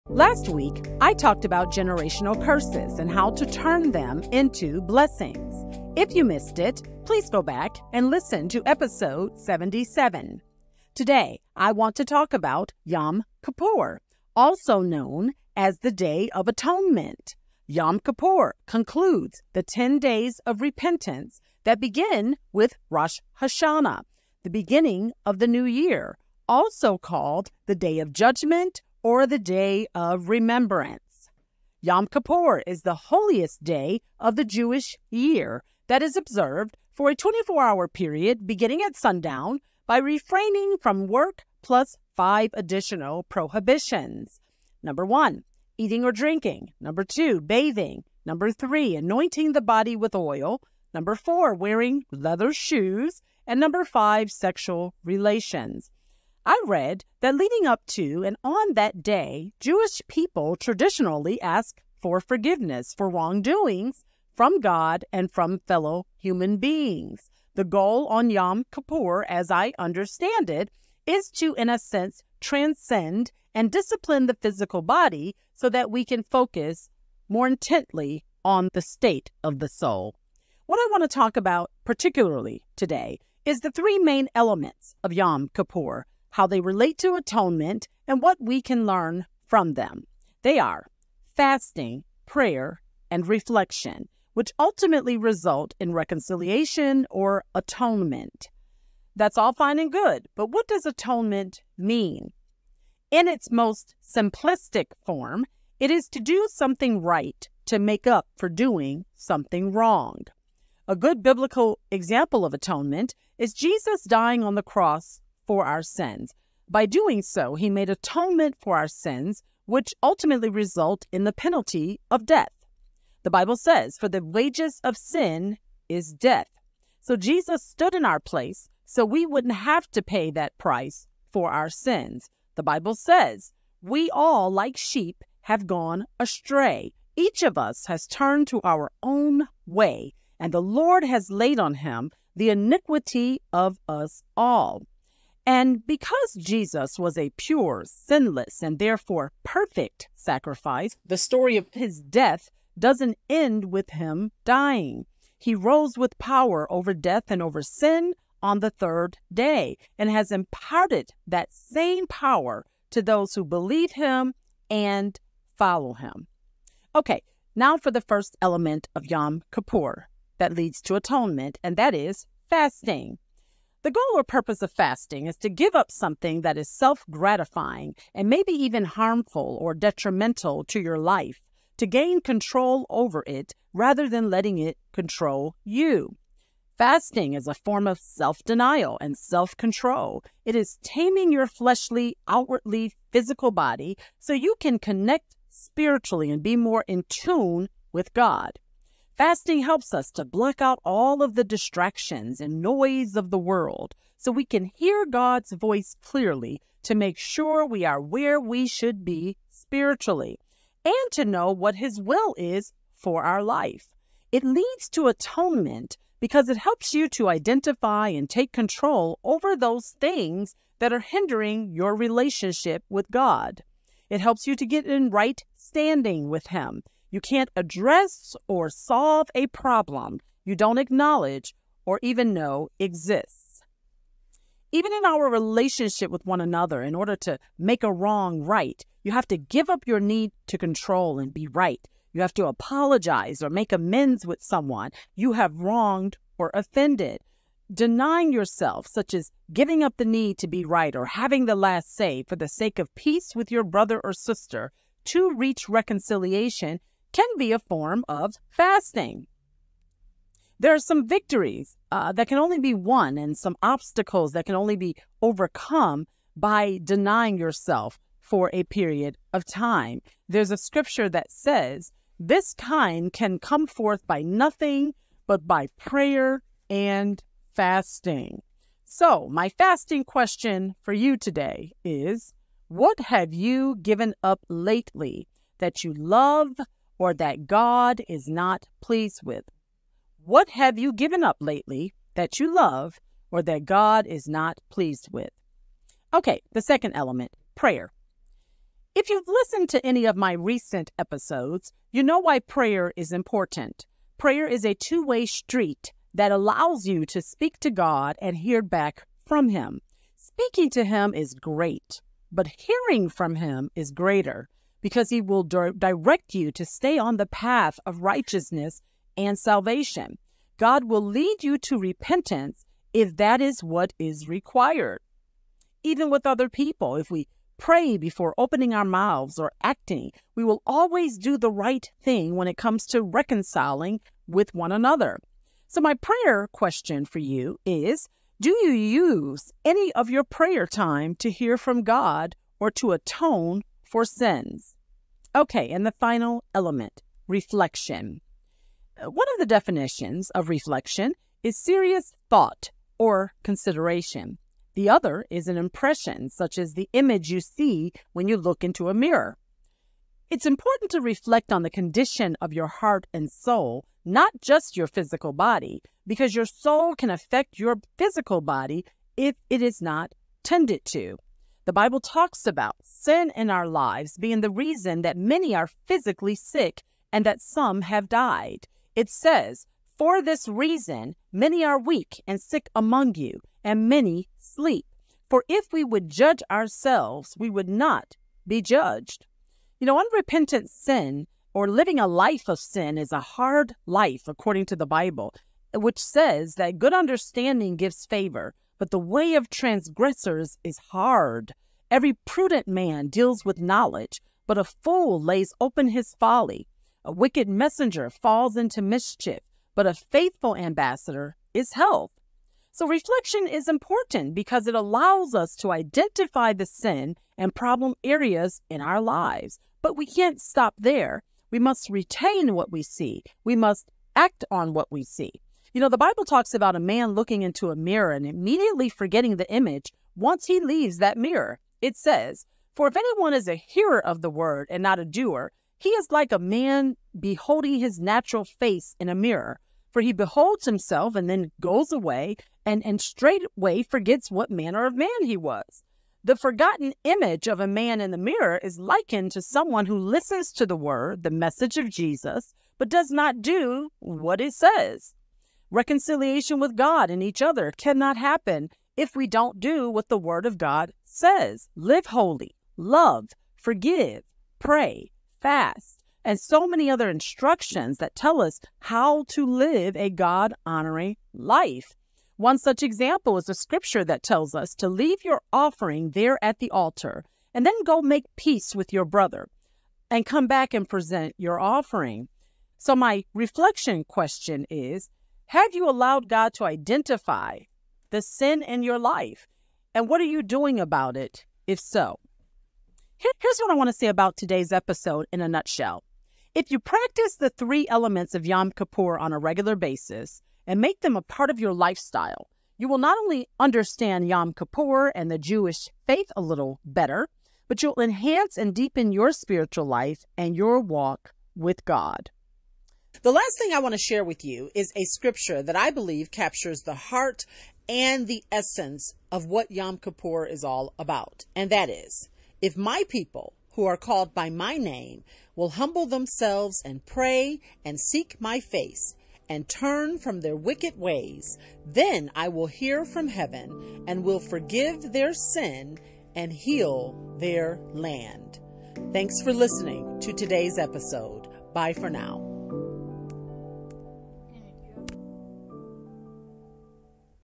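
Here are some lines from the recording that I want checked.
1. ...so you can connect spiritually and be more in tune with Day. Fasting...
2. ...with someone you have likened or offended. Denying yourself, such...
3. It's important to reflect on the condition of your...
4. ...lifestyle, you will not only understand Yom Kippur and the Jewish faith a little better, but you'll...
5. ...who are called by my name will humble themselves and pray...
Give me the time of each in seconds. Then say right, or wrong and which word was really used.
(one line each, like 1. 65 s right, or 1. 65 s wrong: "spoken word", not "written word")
1. 194 s wrong: "God", not "Day"
2. 244 s wrong: "wronged", not "likened"
3. 360 s right
4. 501 s right
5. 523 s right.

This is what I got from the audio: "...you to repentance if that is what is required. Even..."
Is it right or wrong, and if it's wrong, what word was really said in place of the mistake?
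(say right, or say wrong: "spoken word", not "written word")
right.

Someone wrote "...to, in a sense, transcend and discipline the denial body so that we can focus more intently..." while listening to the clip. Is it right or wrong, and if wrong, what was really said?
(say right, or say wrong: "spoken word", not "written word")
wrong: "physical", not "denial".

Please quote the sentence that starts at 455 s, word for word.
Reconciliation with God and each other cannot happen if we don't do what the Word of God says.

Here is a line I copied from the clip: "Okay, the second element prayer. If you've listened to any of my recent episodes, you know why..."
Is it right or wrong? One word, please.
right.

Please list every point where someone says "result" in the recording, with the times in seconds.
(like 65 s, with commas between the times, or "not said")
95 s, 120 s.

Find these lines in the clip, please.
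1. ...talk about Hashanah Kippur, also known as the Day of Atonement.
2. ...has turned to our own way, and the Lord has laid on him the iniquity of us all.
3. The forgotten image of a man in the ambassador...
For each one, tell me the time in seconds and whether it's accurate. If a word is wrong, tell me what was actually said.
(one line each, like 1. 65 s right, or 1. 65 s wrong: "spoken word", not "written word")
1. 12 s wrong: "Yom", not "Hashanah"
2. 137 s right
3. 446 s wrong: "mirror", not "ambassador".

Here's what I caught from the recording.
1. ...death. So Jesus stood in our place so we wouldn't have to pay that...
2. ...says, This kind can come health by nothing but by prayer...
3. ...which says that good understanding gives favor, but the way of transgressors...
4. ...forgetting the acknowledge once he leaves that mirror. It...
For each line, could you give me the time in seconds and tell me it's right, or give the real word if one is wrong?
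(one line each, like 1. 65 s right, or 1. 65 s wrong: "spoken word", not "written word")
1. 126 s right
2. 271 s wrong: "forth", not "health"
3. 395 s right
4. 428 s wrong: "image", not "acknowledge".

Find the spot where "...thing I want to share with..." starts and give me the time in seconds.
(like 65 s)
513 s.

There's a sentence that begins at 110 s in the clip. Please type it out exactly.
A good biblical example of atonement is Jesus dying on the cross for our sins.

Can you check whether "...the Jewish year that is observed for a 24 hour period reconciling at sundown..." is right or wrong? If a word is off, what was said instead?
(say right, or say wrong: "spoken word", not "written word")
wrong: "beginning", not "reconciling".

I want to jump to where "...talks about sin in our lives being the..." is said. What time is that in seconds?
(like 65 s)
371 s.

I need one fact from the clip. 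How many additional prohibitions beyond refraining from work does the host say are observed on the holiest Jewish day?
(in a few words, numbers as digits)
5.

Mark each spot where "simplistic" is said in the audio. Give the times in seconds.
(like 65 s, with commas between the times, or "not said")
104 s.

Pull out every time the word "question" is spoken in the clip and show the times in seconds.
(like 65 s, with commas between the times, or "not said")
280 s, 336 s, 484 s.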